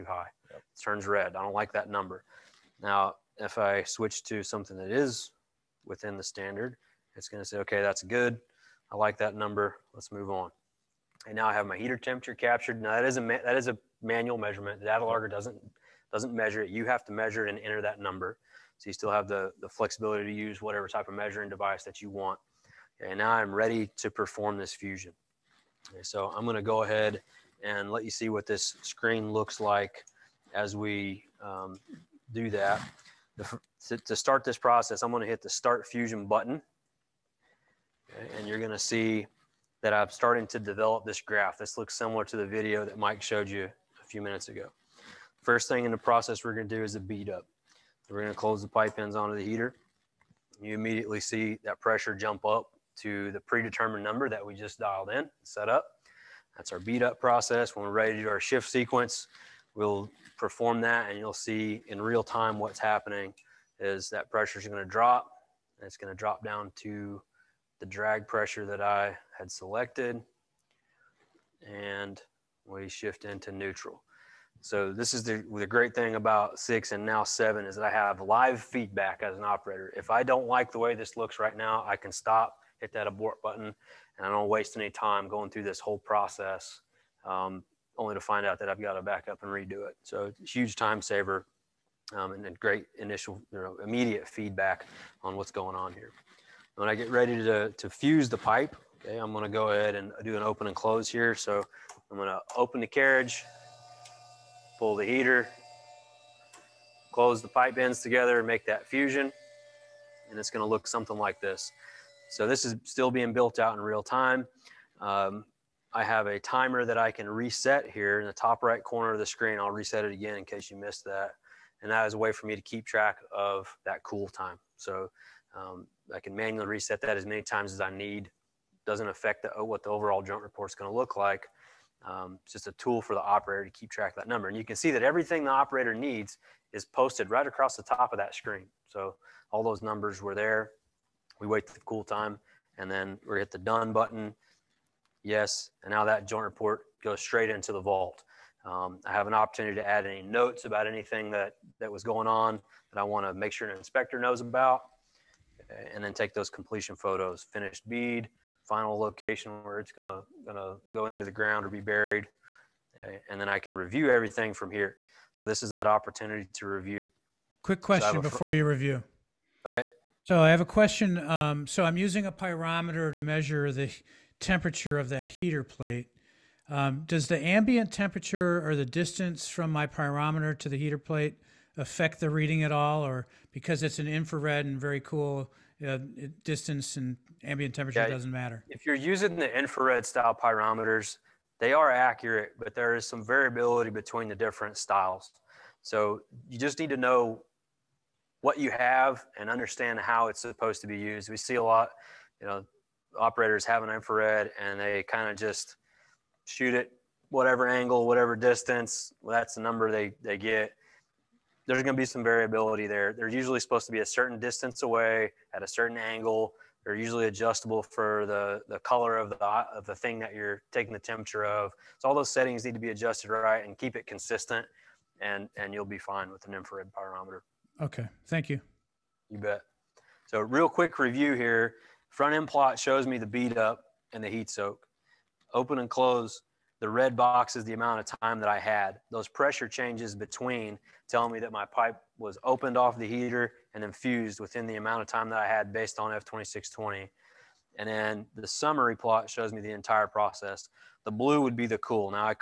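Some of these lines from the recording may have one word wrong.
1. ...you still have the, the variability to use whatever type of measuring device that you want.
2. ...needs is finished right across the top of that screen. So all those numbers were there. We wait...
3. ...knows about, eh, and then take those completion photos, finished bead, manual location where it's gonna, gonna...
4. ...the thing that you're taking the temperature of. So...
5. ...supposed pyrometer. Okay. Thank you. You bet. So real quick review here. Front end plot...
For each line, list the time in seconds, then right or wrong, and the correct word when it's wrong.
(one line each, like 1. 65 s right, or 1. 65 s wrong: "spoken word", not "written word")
1. 18 s wrong: "flexibility", not "variability"
2. 135 s wrong: "posted", not "finished"
3. 154 s wrong: "final", not "manual"
4. 219 s right
5. 226 s wrong: "infrared", not "supposed".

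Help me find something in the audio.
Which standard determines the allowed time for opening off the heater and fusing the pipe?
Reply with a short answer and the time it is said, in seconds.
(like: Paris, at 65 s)
F2620, at 246 s.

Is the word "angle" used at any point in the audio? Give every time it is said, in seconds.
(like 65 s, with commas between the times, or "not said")
207 s, 215 s.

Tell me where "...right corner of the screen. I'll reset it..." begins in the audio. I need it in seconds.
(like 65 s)
118 s.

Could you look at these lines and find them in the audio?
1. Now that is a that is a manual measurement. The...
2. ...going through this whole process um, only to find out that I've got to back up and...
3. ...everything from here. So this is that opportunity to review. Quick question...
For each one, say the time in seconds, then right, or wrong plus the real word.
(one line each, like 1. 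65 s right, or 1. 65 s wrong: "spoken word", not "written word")
1. 12 s right
2. 85 s right
3. 164 s right.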